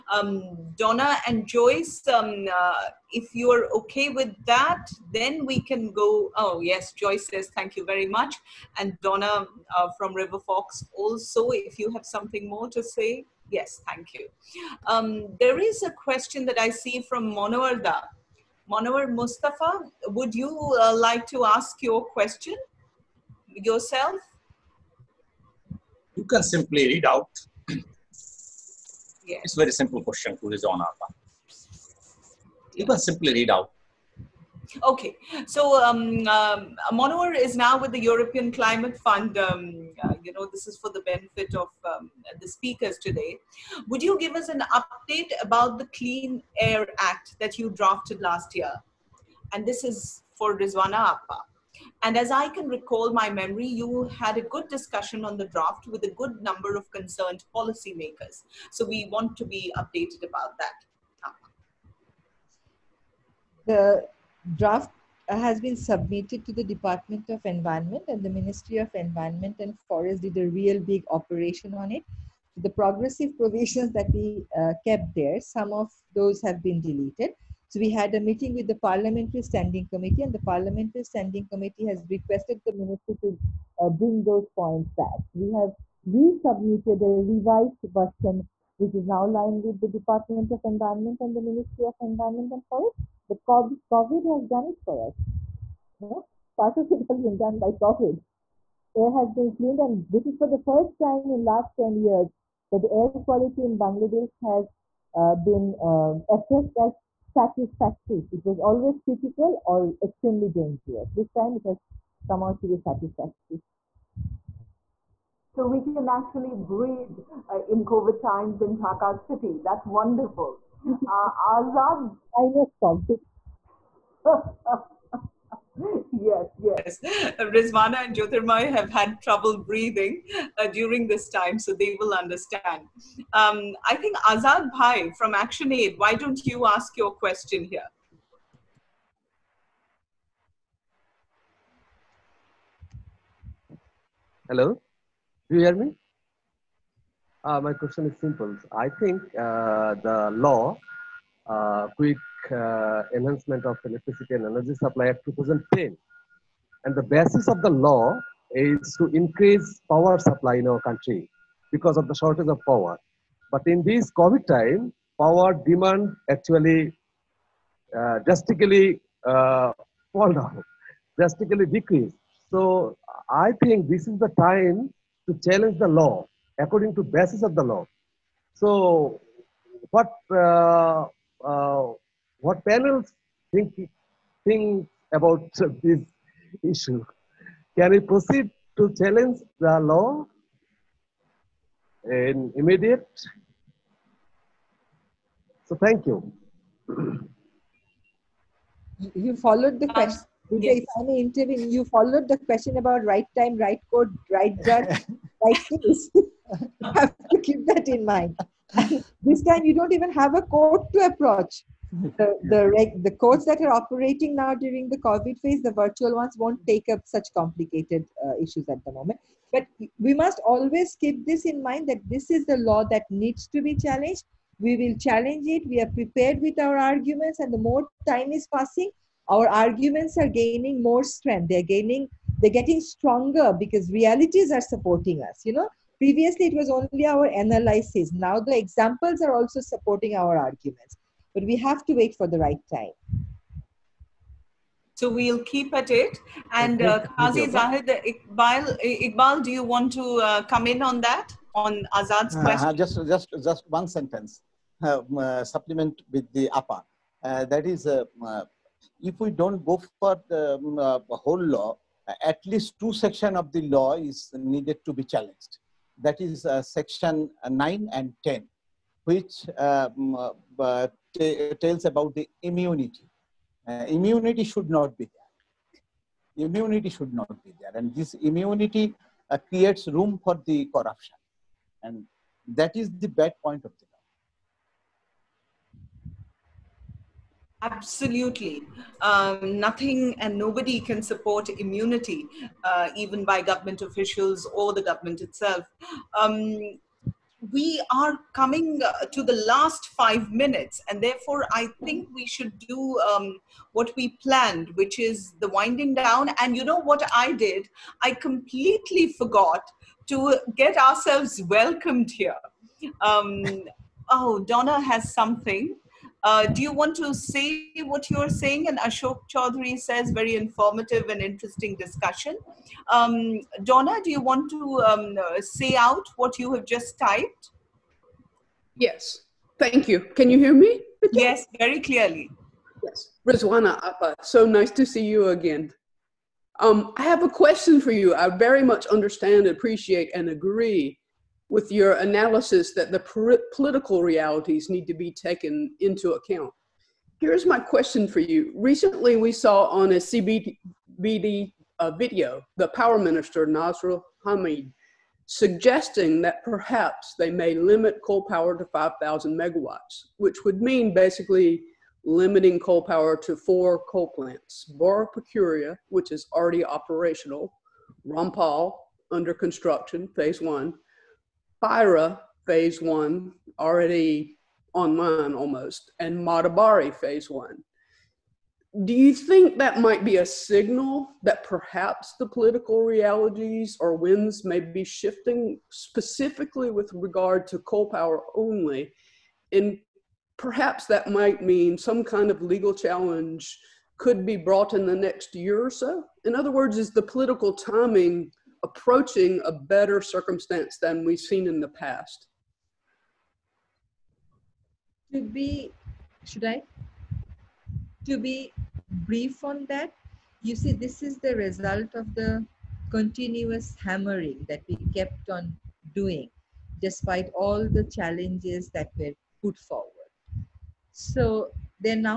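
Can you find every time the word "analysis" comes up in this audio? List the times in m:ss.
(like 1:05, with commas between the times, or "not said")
3:57, 5:41.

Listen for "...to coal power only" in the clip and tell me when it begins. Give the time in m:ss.
6:27.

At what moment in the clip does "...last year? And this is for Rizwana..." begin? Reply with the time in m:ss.
0:48.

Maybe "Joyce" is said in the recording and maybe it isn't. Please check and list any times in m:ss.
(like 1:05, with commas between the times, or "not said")
0:01, 0:06.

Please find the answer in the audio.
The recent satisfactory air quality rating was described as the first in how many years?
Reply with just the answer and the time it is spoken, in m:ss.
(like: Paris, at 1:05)
10, at 1:41.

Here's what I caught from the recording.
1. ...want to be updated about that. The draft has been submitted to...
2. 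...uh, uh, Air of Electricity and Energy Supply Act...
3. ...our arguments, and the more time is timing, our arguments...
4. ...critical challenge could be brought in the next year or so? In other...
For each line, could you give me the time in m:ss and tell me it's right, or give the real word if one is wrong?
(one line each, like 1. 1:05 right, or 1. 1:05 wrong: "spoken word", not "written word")
1. 0:59 right
2. 2:32 wrong: "Enhancement", not "Air"
3. 3:46 wrong: "passing", not "timing"
4. 6:32 wrong: "legal", not "critical".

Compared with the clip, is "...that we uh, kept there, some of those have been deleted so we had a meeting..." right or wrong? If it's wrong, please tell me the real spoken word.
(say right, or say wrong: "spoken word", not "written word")
right.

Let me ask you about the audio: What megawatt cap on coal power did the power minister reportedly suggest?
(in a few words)
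5,000 megawatts.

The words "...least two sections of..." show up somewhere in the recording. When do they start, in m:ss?
4:22.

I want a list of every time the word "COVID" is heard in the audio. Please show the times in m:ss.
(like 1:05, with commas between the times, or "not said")
1:33, 1:37, 1:57, 2:02, 2:44, 3:34.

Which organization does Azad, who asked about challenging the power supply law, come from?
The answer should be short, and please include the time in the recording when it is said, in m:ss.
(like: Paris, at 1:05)
Action Aid, at 2:15.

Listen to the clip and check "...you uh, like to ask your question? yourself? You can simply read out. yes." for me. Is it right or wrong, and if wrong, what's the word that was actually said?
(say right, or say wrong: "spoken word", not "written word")
right.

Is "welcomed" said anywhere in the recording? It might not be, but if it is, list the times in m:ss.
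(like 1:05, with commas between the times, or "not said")
5:11.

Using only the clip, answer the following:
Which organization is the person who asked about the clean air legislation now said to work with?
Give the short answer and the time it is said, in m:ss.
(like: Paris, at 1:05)
European Climate Fund, at 0:37.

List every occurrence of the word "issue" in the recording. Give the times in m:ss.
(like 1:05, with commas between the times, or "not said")
3:06, 3:38.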